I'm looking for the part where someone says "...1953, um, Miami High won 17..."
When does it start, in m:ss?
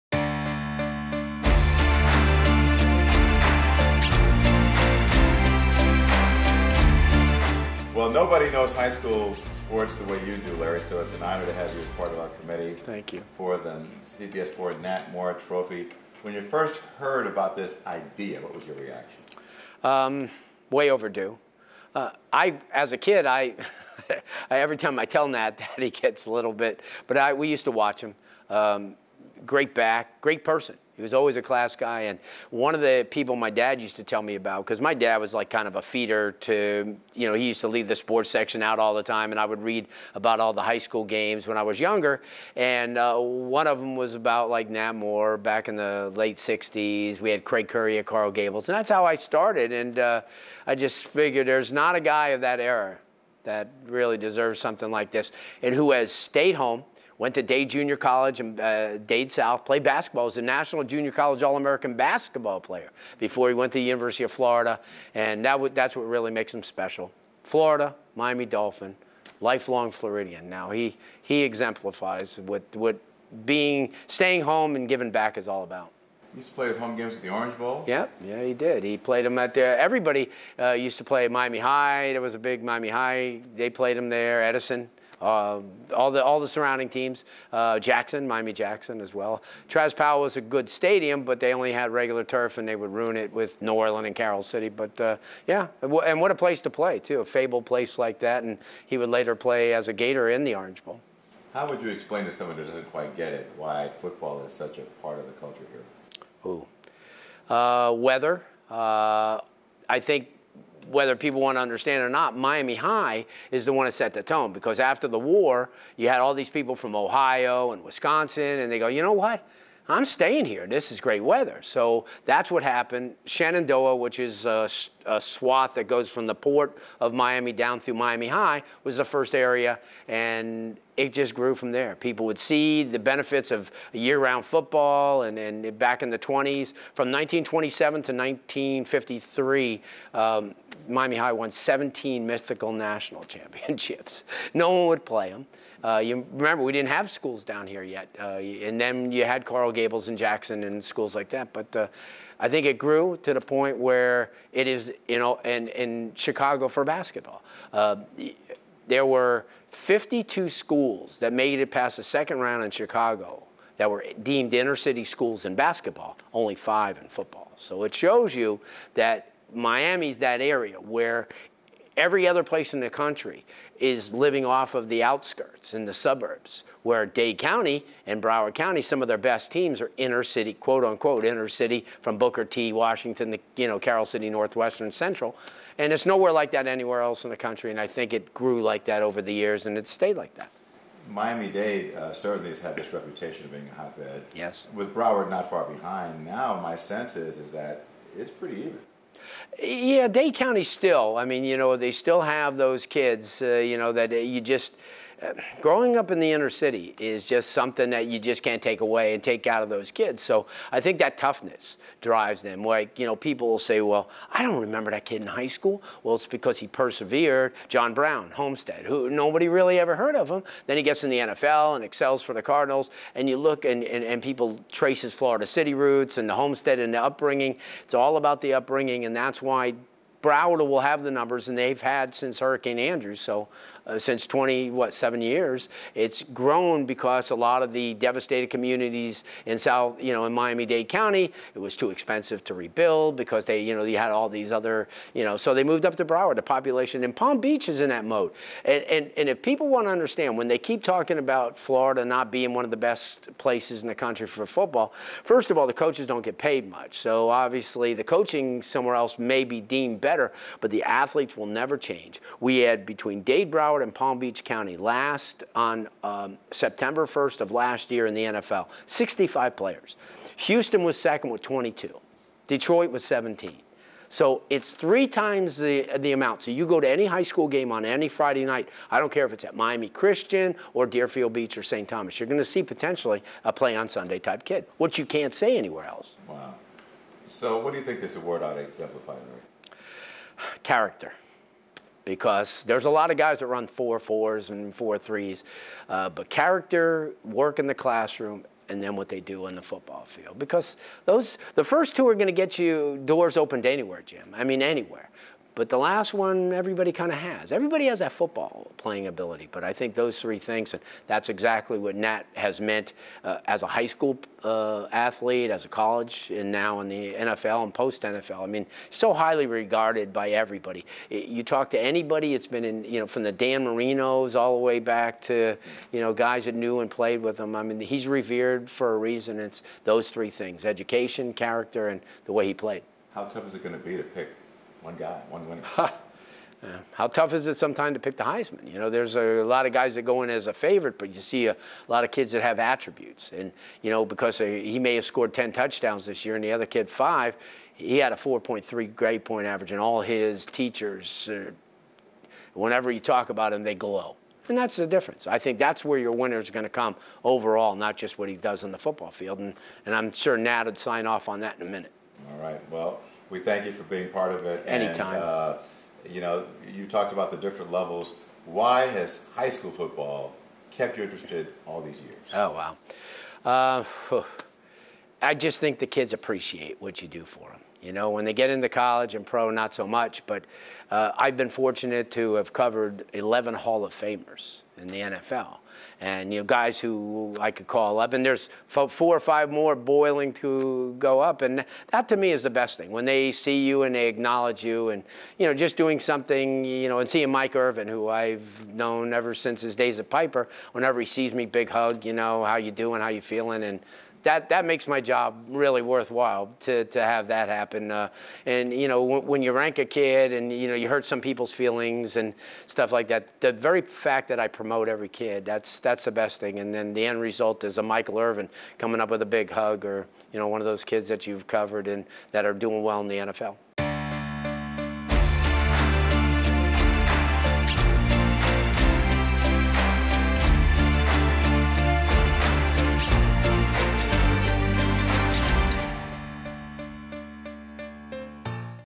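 2:18.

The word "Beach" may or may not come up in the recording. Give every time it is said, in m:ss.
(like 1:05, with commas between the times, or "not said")
4:07, 4:24, 4:41.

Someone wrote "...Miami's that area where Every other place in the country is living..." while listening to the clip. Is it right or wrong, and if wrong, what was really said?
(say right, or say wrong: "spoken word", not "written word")
right.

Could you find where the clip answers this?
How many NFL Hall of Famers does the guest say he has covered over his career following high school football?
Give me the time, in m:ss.
6:23.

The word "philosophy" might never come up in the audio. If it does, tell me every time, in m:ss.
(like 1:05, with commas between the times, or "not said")
not said.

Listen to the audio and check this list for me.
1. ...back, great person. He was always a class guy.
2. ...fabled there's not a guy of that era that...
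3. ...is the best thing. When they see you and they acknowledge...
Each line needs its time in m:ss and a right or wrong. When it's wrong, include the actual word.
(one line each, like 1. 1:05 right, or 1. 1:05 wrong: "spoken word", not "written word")
1. 0:29 right
2. 0:51 wrong: "figured", not "fabled"
3. 6:32 right.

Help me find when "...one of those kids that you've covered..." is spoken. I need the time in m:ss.
7:00.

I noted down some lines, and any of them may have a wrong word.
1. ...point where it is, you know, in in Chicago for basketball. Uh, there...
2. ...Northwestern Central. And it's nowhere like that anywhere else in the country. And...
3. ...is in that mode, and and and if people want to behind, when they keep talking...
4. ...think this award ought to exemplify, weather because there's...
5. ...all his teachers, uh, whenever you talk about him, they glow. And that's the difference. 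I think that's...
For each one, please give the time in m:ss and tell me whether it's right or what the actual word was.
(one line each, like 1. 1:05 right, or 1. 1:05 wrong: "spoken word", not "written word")
1. 2:33 right
2. 3:04 right
3. 4:07 wrong: "understand", not "behind"
4. 4:47 wrong: "character", not "weather"
5. 5:49 right.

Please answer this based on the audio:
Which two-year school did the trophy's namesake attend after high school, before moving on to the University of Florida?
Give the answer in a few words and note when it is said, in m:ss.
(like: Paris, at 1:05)
Dade Junior College, at 0:57.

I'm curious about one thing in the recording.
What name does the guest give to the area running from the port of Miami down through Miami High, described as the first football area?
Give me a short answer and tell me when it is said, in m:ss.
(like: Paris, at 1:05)
Shenandoah, at 2:03.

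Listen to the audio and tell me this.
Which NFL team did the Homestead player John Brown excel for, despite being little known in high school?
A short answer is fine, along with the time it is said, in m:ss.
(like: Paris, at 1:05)
Cardinals, at 3:42.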